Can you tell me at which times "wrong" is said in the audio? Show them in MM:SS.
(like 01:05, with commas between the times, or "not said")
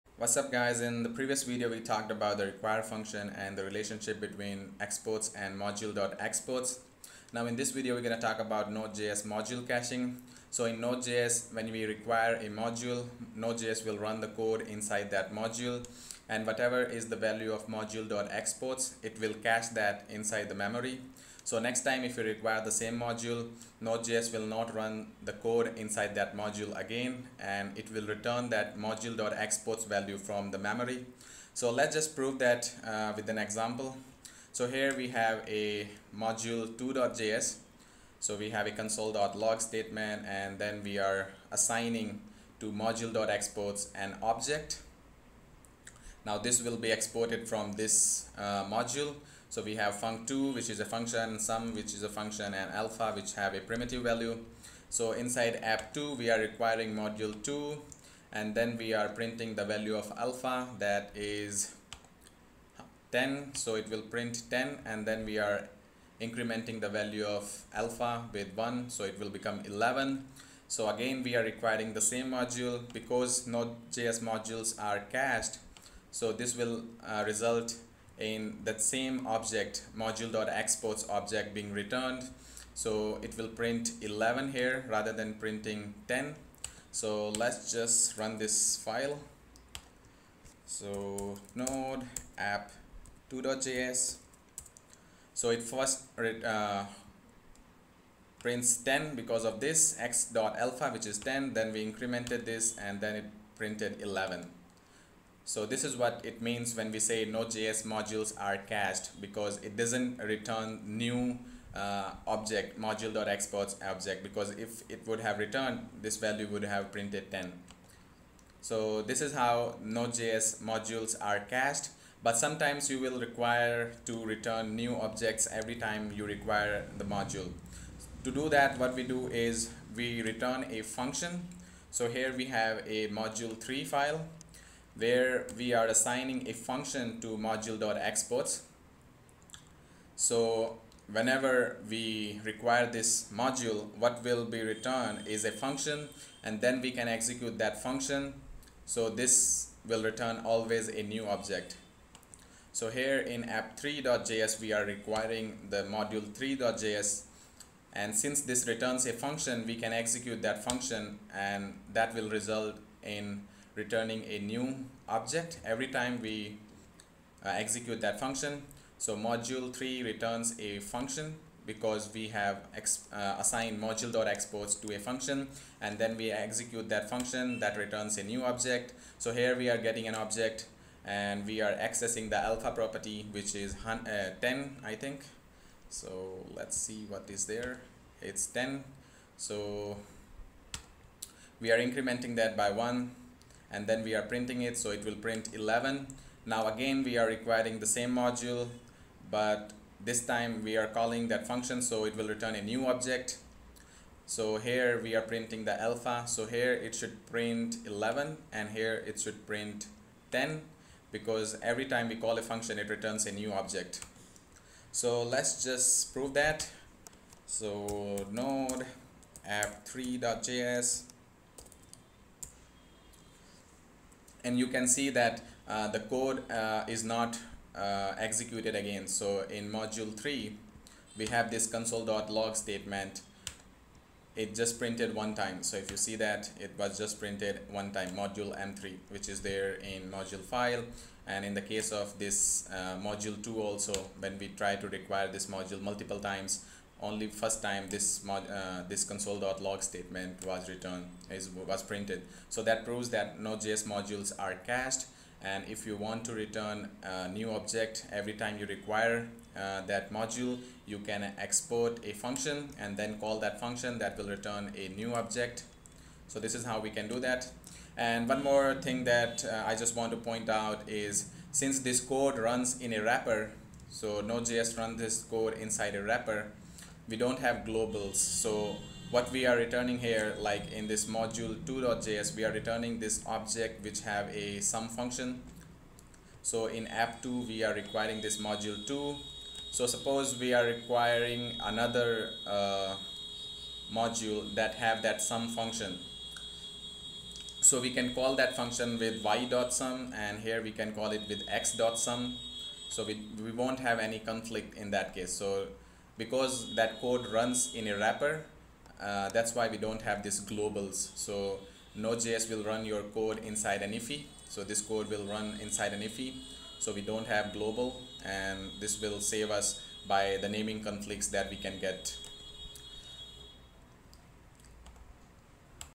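not said.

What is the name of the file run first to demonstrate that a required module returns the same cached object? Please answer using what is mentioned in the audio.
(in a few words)
app2.js.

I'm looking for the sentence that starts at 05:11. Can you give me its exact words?
So Node.js will run your code inside an IIFE.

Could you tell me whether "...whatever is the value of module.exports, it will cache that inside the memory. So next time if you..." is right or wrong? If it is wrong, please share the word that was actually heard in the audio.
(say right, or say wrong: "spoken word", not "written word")
right.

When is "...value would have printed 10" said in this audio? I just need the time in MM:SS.
01:56.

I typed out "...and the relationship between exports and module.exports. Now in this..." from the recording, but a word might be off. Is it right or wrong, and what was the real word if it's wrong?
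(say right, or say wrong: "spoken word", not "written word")
right.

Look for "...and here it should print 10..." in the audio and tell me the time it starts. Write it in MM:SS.
03:28.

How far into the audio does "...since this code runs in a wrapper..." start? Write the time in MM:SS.
04:31.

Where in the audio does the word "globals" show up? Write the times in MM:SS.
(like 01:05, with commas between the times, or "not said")
04:37, 05:10, 05:17.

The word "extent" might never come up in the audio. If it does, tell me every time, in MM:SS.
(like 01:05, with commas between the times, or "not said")
not said.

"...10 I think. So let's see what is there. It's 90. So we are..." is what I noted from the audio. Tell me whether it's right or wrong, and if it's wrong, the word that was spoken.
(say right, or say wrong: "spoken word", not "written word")
wrong: "10", not "90".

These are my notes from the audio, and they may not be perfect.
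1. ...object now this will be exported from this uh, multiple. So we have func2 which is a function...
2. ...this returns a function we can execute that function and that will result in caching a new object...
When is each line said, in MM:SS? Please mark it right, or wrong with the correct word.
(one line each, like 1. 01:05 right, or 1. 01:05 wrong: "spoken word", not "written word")
1. 00:44 wrong: "module", not "multiple"
2. 02:38 wrong: "returning", not "caching".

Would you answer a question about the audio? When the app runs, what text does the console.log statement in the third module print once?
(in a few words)
module m3.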